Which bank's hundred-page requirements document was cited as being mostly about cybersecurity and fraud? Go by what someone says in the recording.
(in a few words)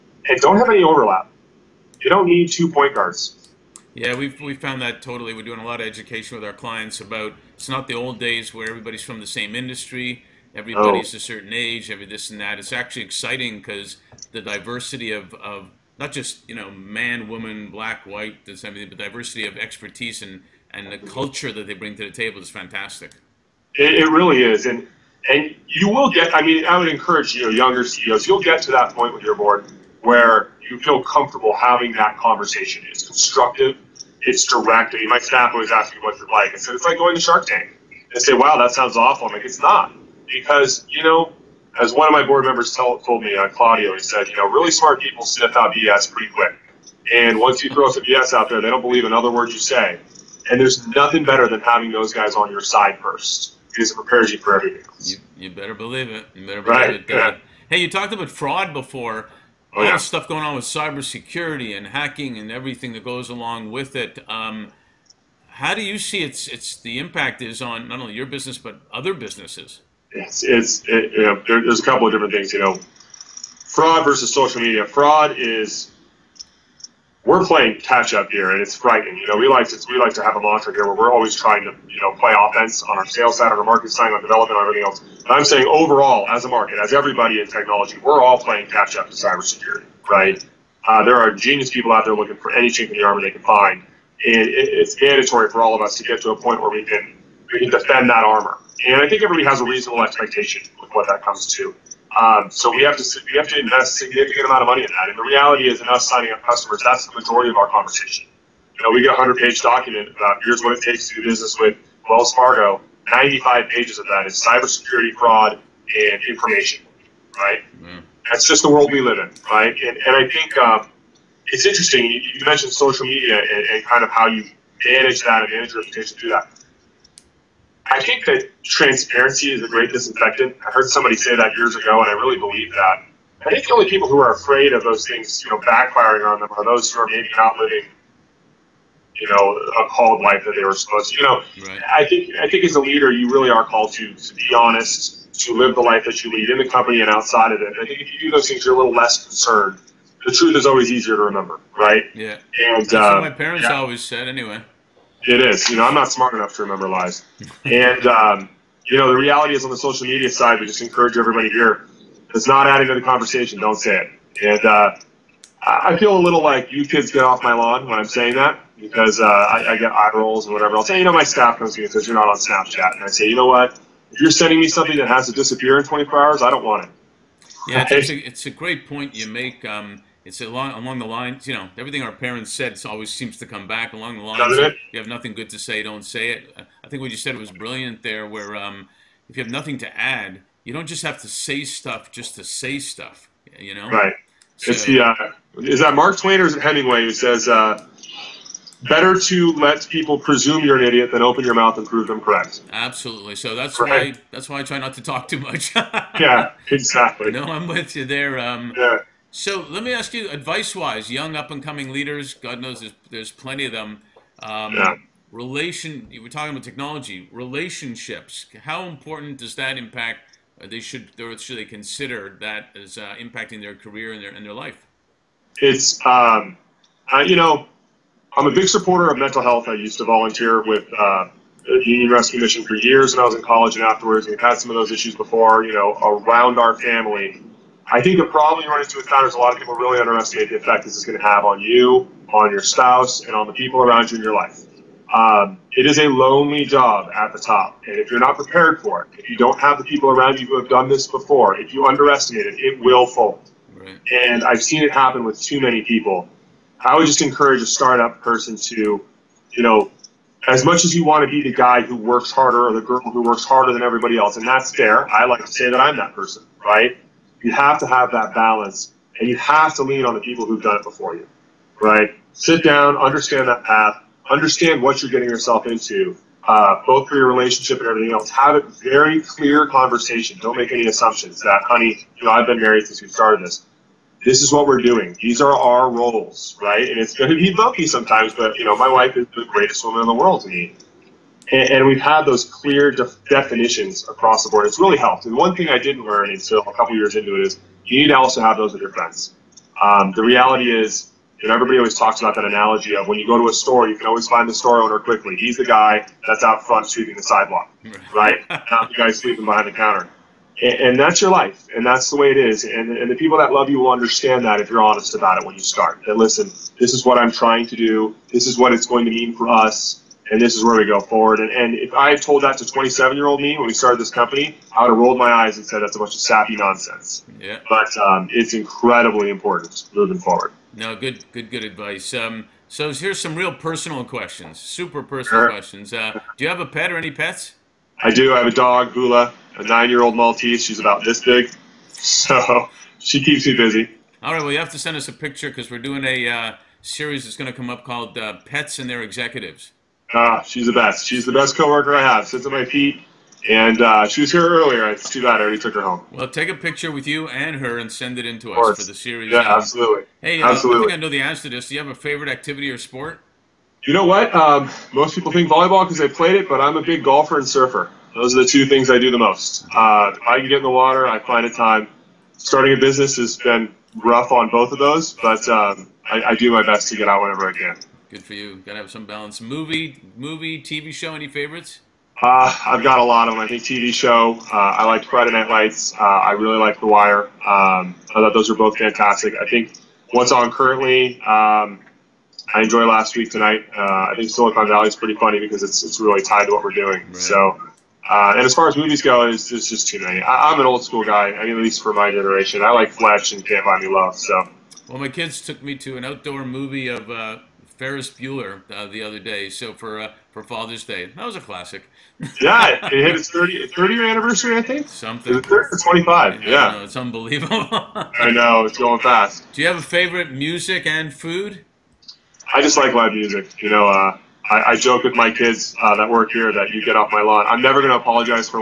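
Wells Fargo.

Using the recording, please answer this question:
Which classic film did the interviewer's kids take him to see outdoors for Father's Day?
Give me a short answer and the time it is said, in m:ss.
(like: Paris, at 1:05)
Ferris Bueller, at 6:47.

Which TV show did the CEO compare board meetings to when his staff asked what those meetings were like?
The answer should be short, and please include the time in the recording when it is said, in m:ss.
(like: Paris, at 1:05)
Shark Tank, at 0:37.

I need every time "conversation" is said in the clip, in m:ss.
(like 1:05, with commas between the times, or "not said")
0:32, 1:47, 2:43, 4:39.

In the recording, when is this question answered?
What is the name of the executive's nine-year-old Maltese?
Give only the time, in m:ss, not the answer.
5:38.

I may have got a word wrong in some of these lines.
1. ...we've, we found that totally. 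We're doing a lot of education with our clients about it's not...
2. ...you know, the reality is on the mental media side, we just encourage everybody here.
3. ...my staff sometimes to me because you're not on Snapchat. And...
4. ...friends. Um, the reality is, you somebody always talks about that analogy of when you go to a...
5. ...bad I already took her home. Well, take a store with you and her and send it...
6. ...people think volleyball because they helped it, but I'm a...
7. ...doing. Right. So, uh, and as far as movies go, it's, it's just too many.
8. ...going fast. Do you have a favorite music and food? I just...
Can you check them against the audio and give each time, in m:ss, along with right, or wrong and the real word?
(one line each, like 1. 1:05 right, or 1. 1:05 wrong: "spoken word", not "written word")
1. 0:04 right
2. 2:38 wrong: "social", not "mental"
3. 2:51 wrong: "comes", not "sometimes"
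4. 4:58 wrong: "everybody", not "somebody"
5. 5:55 wrong: "picture", not "store"
6. 6:05 wrong: "played", not "helped"
7. 6:36 right
8. 6:58 right.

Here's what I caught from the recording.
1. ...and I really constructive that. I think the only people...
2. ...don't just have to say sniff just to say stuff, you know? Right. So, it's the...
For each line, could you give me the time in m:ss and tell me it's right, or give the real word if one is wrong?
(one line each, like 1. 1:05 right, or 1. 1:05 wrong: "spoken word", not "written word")
1. 2:12 wrong: "believe", not "constructive"
2. 3:10 wrong: "stuff", not "sniff".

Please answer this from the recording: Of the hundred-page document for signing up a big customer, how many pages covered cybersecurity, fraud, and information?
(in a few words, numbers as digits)
95.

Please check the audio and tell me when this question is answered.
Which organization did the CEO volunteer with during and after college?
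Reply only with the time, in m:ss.
3:51.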